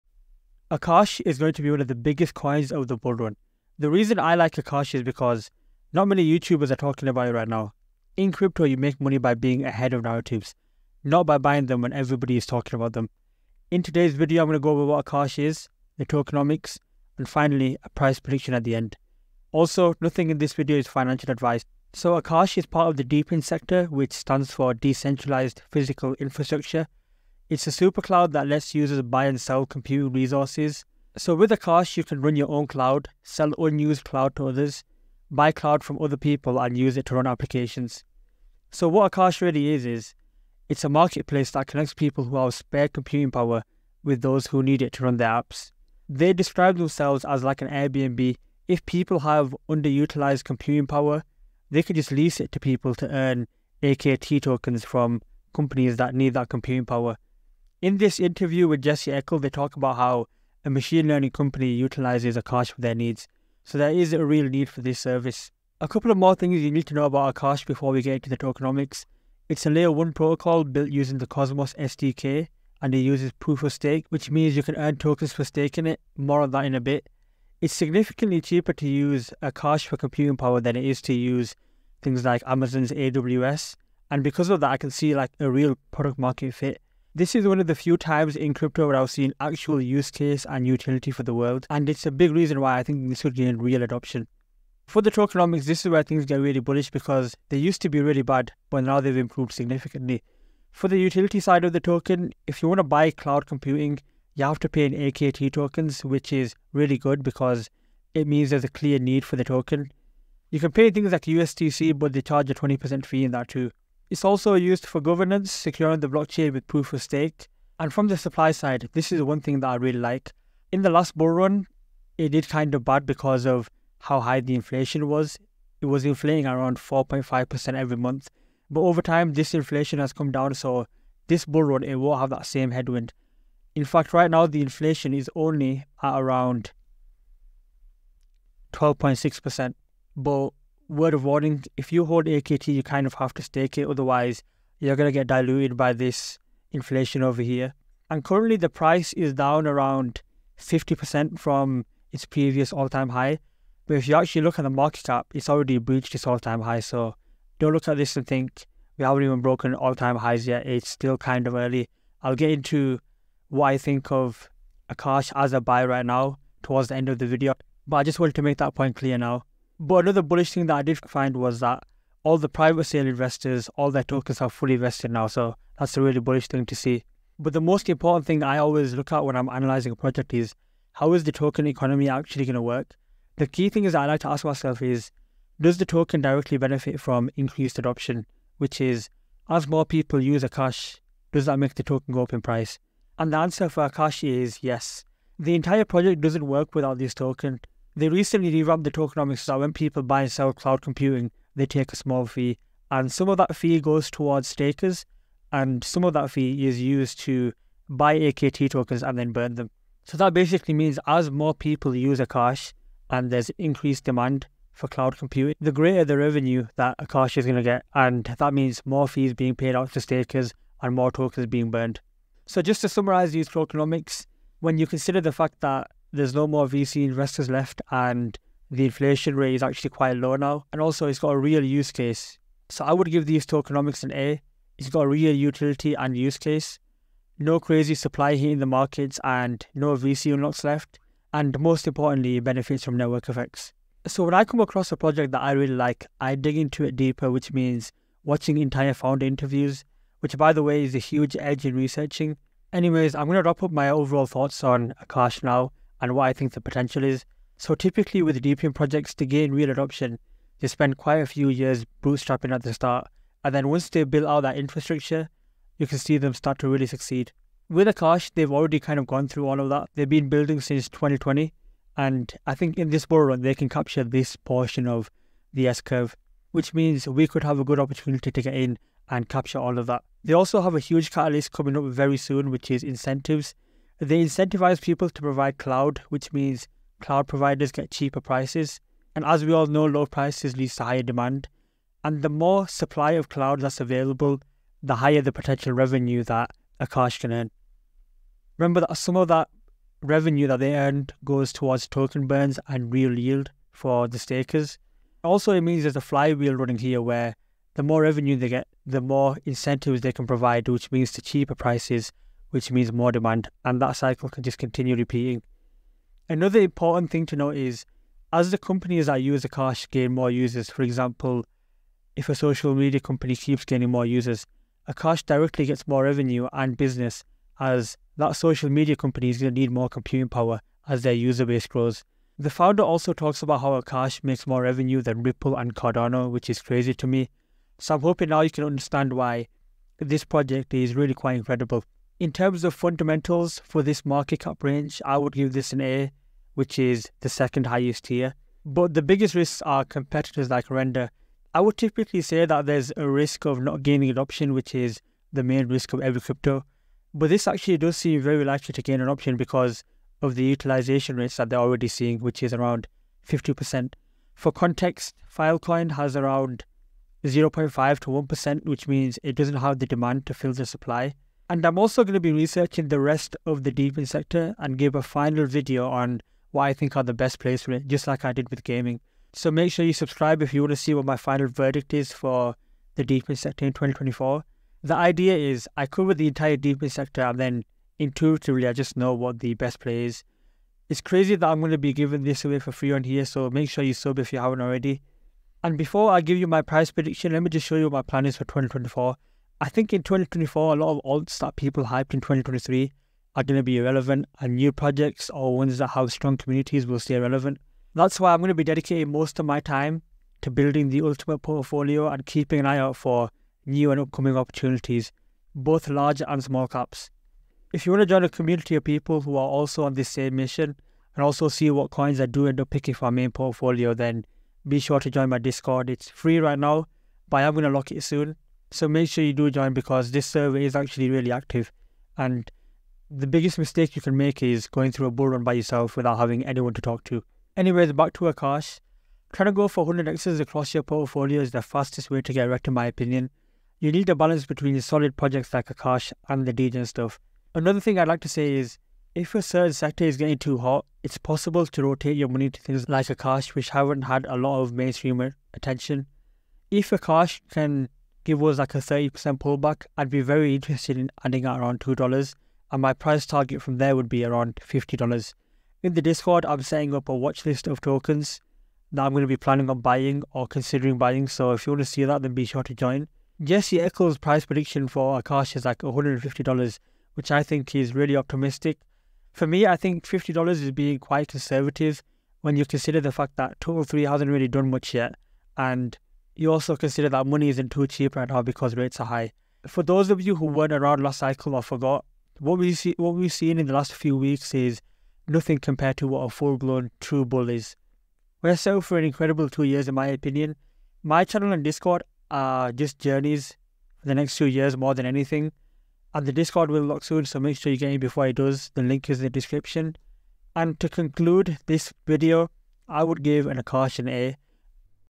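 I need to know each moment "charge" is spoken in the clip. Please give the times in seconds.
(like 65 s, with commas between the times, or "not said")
112 s.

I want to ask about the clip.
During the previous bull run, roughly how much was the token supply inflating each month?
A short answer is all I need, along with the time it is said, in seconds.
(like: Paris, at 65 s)
4.5%, at 126 s.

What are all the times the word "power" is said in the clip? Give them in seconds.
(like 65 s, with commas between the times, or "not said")
43 s, 50 s, 56 s, 80 s, 330 s.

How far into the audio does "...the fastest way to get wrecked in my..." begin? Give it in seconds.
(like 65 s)
441 s.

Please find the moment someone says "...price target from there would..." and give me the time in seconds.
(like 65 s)
462 s.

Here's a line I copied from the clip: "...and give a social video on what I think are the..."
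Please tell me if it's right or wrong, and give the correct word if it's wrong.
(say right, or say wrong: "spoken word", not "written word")
wrong: "final", not "social".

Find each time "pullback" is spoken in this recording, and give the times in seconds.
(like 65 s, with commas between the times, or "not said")
459 s.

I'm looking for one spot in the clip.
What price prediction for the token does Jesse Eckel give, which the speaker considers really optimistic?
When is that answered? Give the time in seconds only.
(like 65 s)
475 s.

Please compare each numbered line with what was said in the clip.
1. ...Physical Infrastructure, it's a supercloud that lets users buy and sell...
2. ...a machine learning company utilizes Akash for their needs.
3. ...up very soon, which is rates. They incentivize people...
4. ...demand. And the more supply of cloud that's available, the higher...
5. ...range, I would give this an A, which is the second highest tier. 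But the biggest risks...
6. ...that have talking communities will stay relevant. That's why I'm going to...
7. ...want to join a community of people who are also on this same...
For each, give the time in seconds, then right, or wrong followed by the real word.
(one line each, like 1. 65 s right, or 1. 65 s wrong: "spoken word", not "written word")
1. 25 s right
2. 60 s right
3. 281 s wrong: "incentives", not "rates"
4. 291 s right
5. 344 s right
6. 405 s wrong: "strong", not "talking"
7. 417 s right.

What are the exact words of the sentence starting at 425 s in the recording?
It's free right now, but I'm going to lock it soon.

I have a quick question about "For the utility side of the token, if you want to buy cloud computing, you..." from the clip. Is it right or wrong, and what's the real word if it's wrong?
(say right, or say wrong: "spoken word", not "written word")
right.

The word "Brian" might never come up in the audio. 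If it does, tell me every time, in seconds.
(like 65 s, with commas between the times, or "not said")
not said.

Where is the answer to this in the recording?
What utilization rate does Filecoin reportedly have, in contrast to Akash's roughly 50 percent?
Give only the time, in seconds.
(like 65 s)
367 s.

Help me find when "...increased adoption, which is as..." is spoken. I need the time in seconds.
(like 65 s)
187 s.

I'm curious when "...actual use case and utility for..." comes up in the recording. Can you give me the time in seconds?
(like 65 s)
89 s.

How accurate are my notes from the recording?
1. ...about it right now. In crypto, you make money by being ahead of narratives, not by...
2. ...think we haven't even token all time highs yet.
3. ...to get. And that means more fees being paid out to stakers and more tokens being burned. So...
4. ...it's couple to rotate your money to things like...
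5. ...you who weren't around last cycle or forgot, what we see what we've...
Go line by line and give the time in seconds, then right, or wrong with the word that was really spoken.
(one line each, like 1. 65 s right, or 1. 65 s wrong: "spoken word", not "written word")
1. 7 s right
2. 158 s wrong: "broken", not "token"
3. 217 s right
4. 451 s wrong: "possible", not "couple"
5. 490 s right.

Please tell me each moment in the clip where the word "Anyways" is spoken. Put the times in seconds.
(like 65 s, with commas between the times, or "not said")
252 s, 437 s.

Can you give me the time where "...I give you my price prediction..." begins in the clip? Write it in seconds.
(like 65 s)
396 s.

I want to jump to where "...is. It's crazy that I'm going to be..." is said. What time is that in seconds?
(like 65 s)
390 s.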